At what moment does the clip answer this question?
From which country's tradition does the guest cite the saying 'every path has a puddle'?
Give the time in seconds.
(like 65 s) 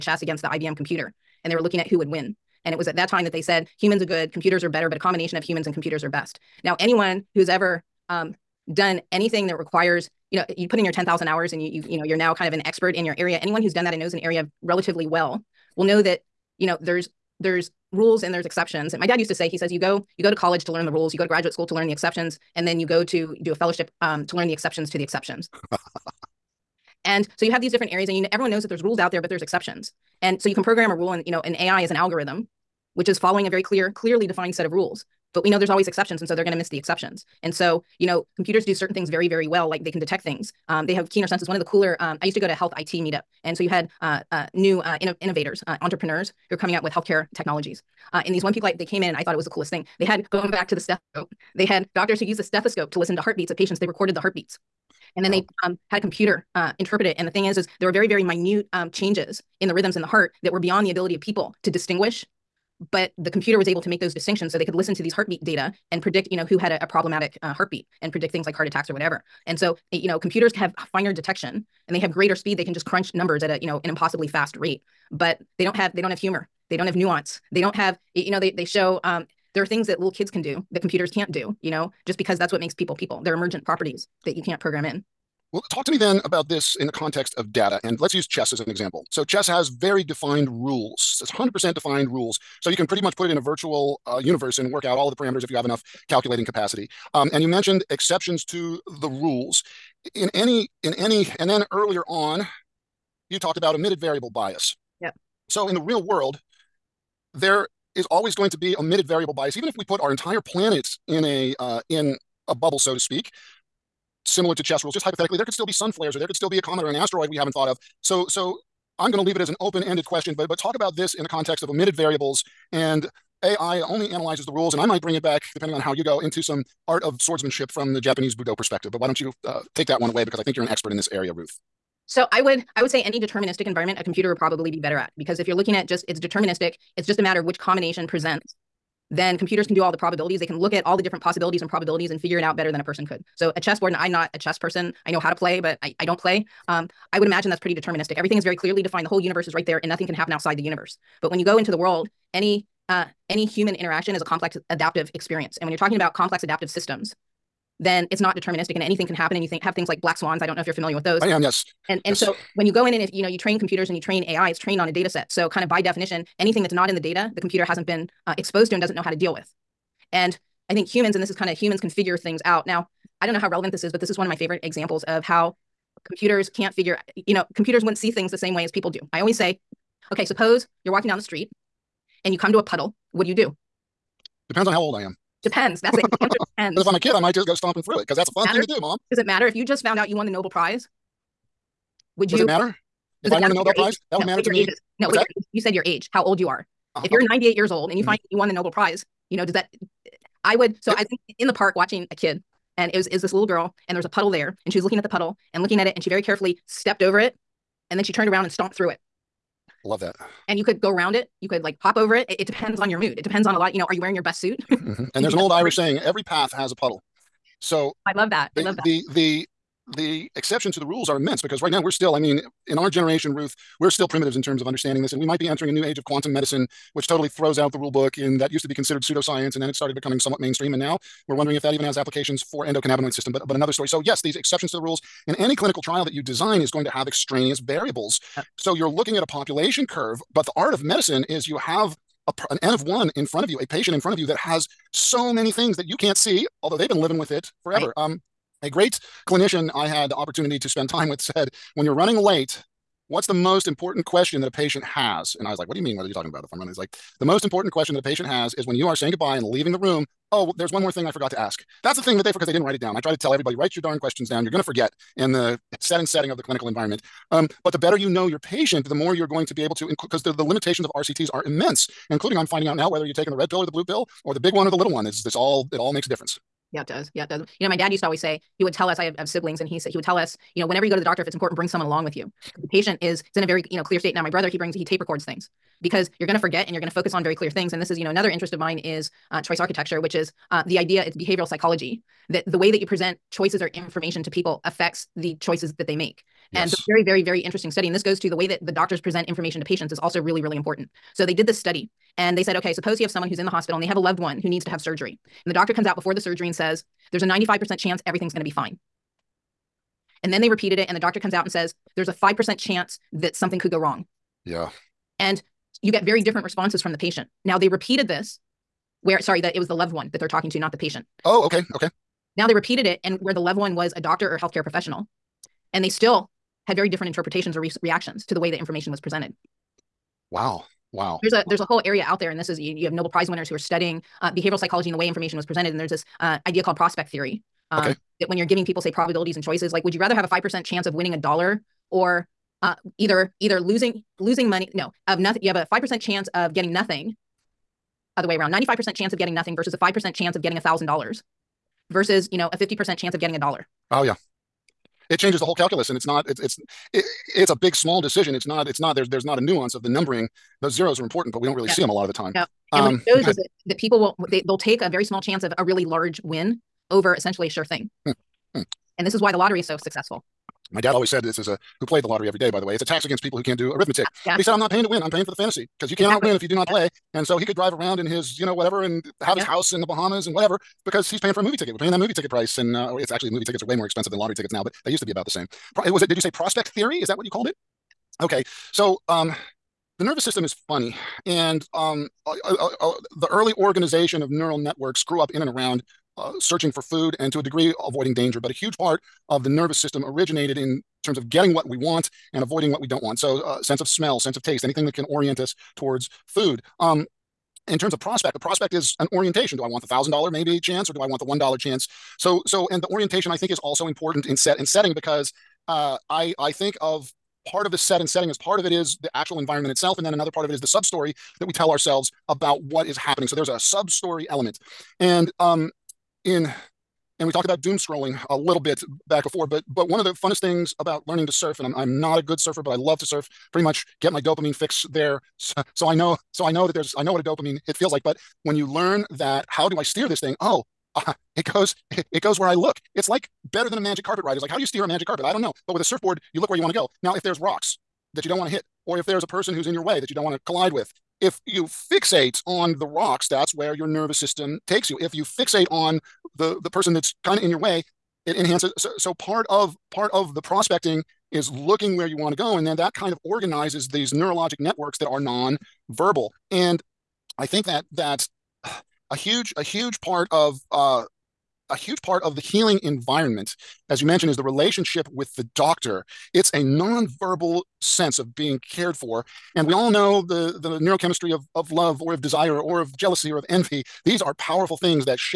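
215 s.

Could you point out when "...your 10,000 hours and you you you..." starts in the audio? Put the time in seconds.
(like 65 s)
10 s.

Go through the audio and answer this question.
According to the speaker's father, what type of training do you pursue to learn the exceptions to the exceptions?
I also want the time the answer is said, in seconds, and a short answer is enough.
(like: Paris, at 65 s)
a fellowship, at 23 s.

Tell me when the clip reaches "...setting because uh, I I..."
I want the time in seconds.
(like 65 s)
414 s.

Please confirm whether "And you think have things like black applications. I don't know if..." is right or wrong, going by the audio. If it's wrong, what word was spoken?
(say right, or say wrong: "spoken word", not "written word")
wrong: "swans", not "applications".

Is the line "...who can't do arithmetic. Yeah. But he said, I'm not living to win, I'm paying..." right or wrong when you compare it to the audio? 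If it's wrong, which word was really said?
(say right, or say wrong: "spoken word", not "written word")
wrong: "paying", not "living".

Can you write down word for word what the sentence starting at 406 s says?
Um, in terms of prospect, a prospect is an orientation.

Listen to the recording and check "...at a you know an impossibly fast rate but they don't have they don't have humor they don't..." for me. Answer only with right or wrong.
right.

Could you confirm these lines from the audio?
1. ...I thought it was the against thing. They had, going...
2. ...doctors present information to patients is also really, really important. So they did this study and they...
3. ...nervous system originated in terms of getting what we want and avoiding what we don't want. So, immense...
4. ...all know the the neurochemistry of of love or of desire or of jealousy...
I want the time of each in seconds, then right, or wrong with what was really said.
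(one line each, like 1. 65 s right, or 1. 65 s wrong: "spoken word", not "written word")
1. 49 s wrong: "coolest", not "against"
2. 298 s right
3. 399 s wrong: "sense", not "immense"
4. 479 s right.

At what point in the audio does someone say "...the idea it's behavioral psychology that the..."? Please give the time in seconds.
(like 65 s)
290 s.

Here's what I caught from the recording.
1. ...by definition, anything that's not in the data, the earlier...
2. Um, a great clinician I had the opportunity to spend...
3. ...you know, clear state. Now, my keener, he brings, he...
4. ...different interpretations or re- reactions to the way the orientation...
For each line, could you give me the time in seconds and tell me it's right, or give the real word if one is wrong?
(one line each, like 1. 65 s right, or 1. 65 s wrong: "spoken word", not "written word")
1. 165 s wrong: "computer", not "earlier"
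2. 248 s right
3. 283 s wrong: "brother", not "keener"
4. 326 s wrong: "information", not "orientation".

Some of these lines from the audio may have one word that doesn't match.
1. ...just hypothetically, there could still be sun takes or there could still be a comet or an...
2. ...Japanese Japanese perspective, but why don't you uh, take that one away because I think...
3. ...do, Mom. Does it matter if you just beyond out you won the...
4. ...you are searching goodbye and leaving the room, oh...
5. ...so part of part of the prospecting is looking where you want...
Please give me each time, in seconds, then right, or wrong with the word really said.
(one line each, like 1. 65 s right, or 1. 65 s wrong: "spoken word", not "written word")
1. 114 s wrong: "flares", not "takes"
2. 127 s wrong: "Budo", not "Japanese"
3. 188 s wrong: "found", not "beyond"
4. 258 s wrong: "saying", not "searching"
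5. 458 s right.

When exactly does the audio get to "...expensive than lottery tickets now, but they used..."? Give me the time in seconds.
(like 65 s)
383 s.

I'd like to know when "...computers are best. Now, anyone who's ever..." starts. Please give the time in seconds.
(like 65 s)
5 s.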